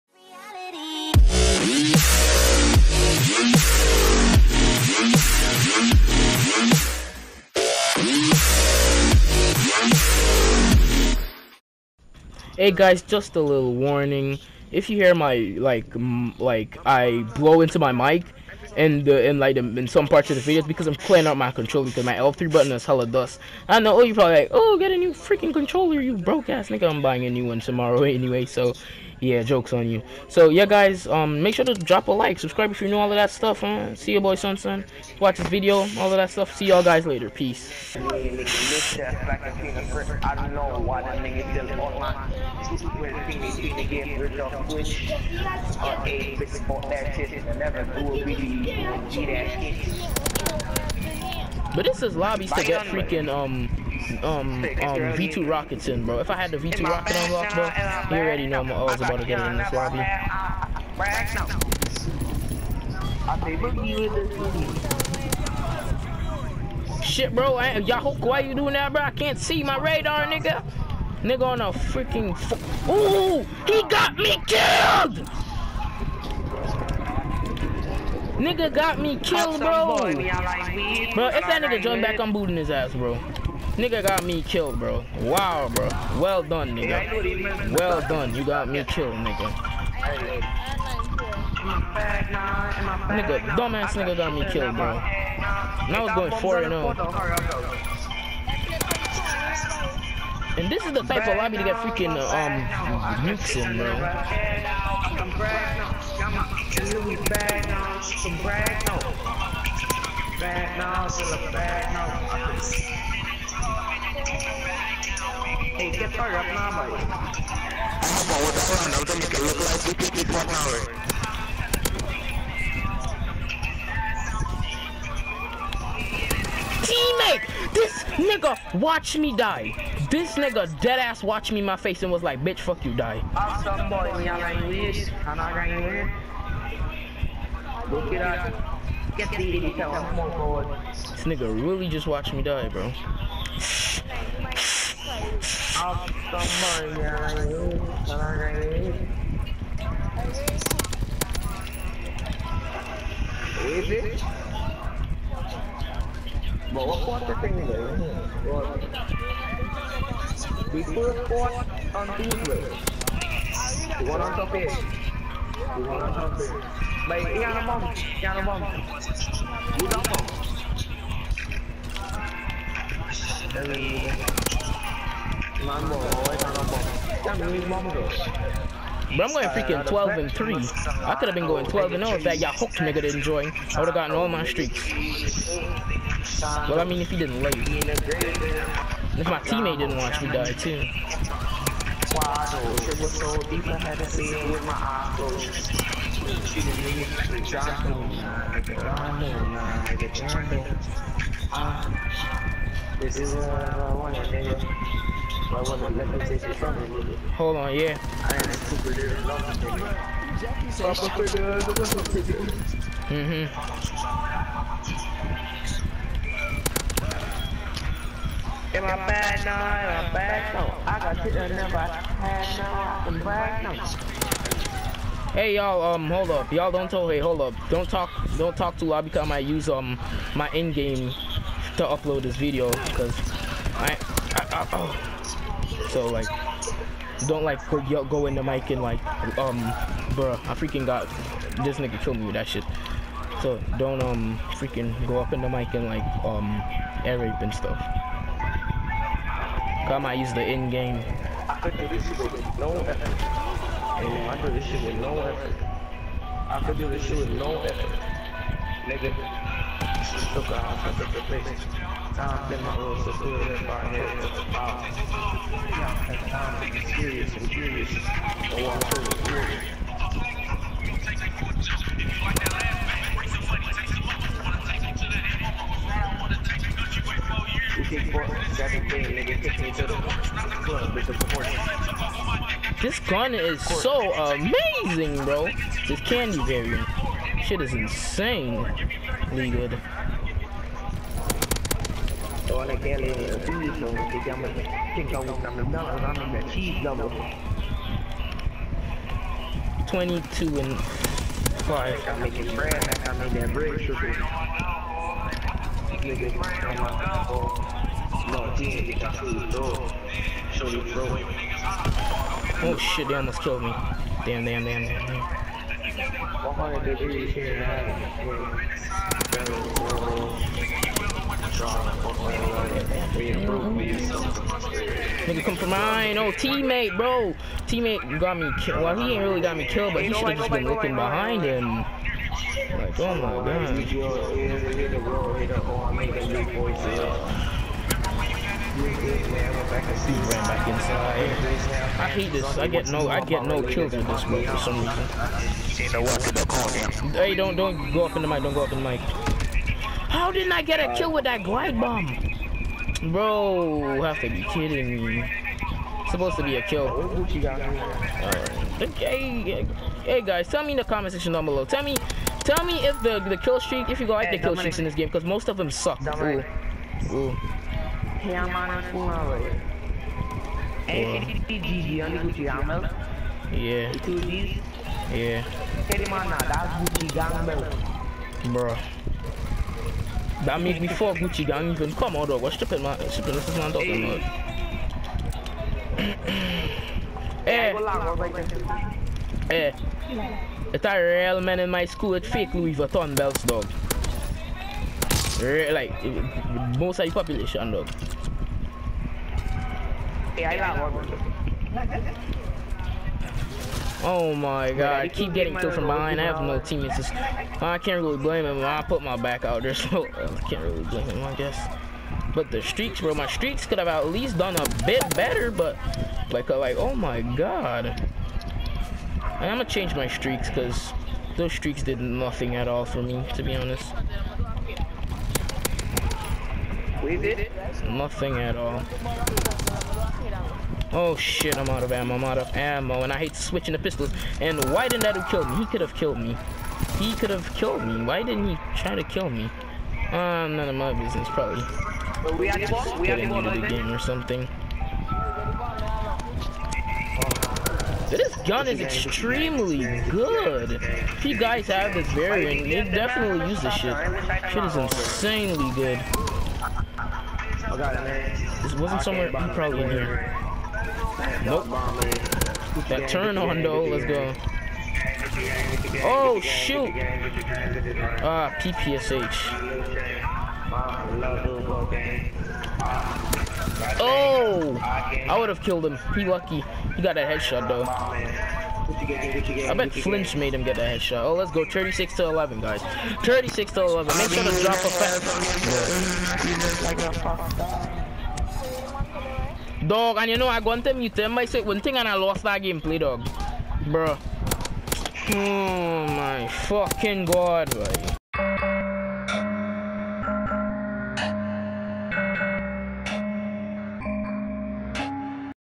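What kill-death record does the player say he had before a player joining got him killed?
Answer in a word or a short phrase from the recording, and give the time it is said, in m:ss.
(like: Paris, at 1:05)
12 and 3, at 2:59.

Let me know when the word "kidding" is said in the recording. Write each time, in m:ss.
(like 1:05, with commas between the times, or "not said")
5:54.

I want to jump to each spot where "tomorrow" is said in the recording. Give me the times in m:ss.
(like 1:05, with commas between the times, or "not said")
0:27.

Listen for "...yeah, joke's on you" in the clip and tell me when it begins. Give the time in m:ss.
0:29.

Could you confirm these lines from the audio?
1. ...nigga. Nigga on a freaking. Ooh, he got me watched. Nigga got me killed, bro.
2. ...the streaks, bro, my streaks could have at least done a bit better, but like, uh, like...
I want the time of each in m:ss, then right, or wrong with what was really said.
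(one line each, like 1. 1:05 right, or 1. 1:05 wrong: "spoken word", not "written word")
1. 1:10 wrong: "killed", not "watched"
2. 6:52 right.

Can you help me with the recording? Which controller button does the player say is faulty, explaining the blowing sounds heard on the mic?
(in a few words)
L3.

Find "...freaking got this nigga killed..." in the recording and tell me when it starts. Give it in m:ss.
4:00.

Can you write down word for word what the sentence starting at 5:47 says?
Hey, don't don't go up in the mic.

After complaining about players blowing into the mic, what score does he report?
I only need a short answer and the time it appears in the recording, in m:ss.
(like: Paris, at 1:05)
22 and 5, at 4:59.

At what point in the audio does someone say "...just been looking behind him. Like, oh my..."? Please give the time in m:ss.
5:30.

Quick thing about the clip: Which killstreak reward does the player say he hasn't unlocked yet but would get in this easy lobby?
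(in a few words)
V2 rocket.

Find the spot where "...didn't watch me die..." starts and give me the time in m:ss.
3:09.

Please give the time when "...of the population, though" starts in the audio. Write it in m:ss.
6:36.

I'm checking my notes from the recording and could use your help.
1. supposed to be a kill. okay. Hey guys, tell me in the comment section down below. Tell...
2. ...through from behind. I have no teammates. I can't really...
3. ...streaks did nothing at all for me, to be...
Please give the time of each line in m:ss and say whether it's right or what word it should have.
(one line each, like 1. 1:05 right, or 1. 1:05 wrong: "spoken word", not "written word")
1. 5:56 right
2. 6:45 right
3. 7:01 right.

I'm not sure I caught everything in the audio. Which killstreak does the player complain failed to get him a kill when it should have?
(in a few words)
glide bomb.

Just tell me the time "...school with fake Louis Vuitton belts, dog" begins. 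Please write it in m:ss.
6:31.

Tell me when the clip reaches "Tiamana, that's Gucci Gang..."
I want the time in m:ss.
6:15.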